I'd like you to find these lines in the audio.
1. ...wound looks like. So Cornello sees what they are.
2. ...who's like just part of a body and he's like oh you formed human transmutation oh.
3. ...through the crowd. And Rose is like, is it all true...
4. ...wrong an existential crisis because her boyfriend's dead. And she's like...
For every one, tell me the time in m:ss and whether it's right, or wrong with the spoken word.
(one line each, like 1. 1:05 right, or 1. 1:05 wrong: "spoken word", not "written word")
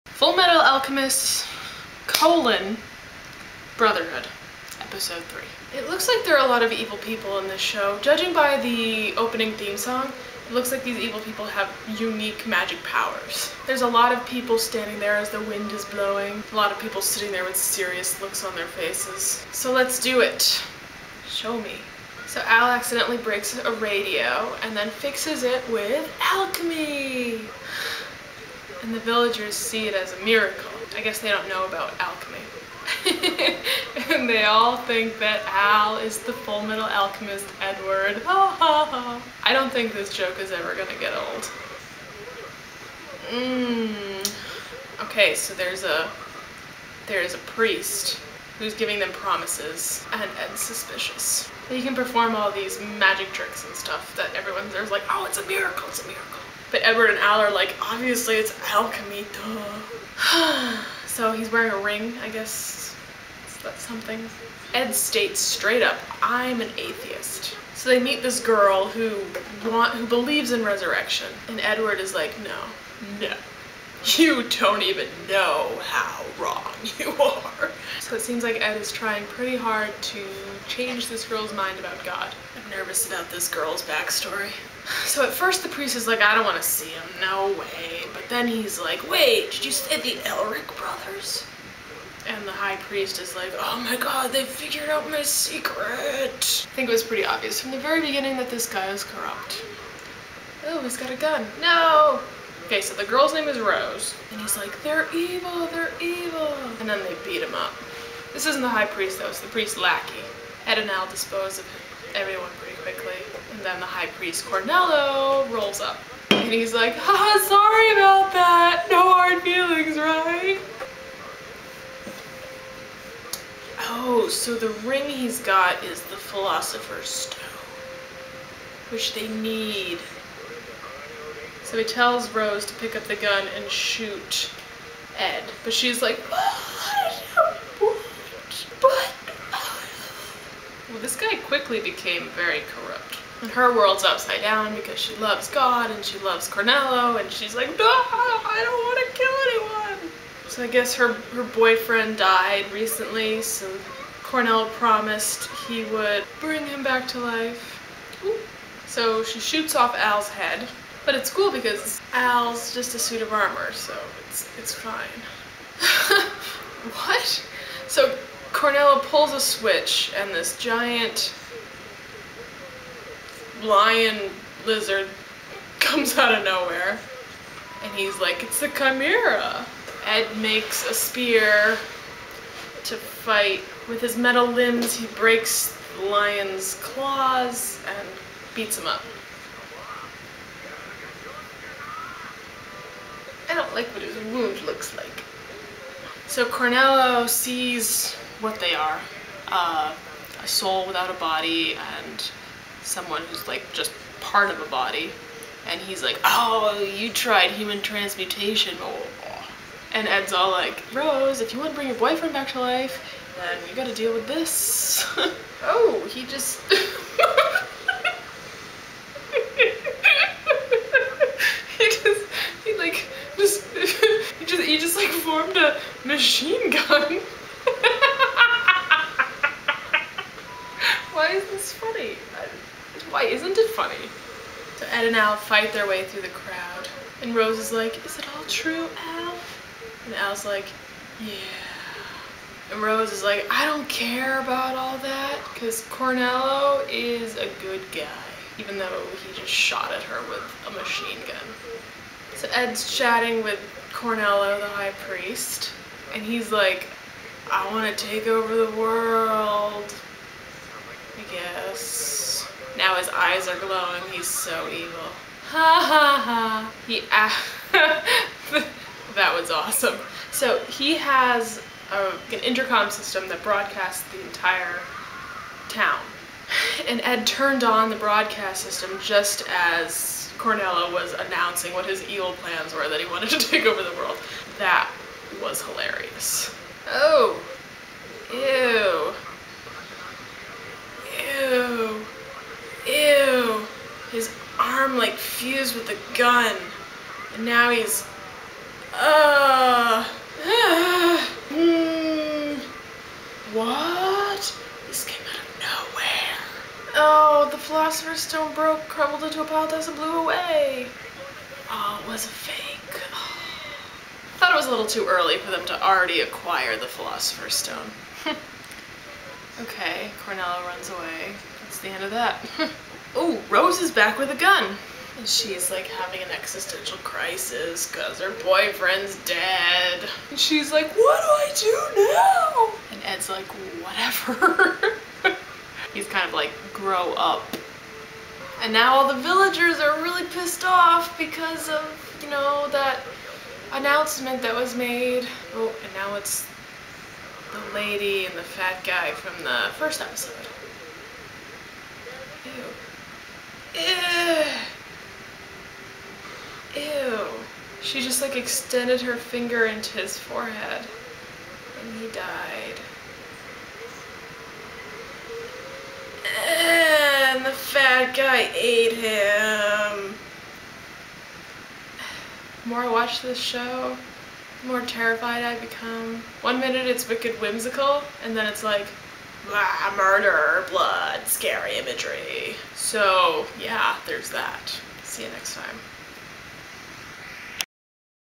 1. 3:14 right
2. 3:23 wrong: "tried", not "formed"
3. 3:56 right
4. 5:25 wrong: "having", not "wrong".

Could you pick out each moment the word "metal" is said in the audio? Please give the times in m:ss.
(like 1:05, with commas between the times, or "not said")
0:36, 3:04.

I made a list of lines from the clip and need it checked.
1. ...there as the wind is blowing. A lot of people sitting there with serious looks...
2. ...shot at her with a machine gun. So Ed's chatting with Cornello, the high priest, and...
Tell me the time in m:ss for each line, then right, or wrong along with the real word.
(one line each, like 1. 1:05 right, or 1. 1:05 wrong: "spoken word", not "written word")
1. 0:14 right
2. 4:09 right.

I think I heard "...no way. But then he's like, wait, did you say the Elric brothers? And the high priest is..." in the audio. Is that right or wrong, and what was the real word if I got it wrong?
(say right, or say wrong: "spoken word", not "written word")
right.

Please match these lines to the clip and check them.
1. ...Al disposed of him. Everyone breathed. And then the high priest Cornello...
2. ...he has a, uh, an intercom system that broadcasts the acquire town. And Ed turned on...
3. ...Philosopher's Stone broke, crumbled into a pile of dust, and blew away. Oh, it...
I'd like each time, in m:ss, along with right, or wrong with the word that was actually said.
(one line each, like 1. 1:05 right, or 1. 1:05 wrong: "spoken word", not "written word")
1. 1:50 right
2. 4:30 wrong: "entire", not "acquire"
3. 5:07 right.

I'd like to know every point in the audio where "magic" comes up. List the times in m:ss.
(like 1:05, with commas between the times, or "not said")
0:12, 0:52.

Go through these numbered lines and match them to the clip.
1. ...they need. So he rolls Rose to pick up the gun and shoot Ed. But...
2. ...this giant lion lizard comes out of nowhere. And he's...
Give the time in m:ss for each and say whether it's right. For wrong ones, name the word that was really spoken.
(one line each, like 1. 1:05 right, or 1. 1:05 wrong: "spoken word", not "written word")
1. 2:09 wrong: "tells", not "rolls"
2. 2:50 right.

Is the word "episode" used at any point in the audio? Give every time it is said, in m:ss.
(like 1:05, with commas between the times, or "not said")
0:04, 5:50.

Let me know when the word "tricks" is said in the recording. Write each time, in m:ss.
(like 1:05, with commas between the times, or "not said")
0:53.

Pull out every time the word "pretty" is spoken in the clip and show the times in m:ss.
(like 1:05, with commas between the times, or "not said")
1:19, 1:37.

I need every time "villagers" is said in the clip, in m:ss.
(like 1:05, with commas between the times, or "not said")
0:29, 5:39.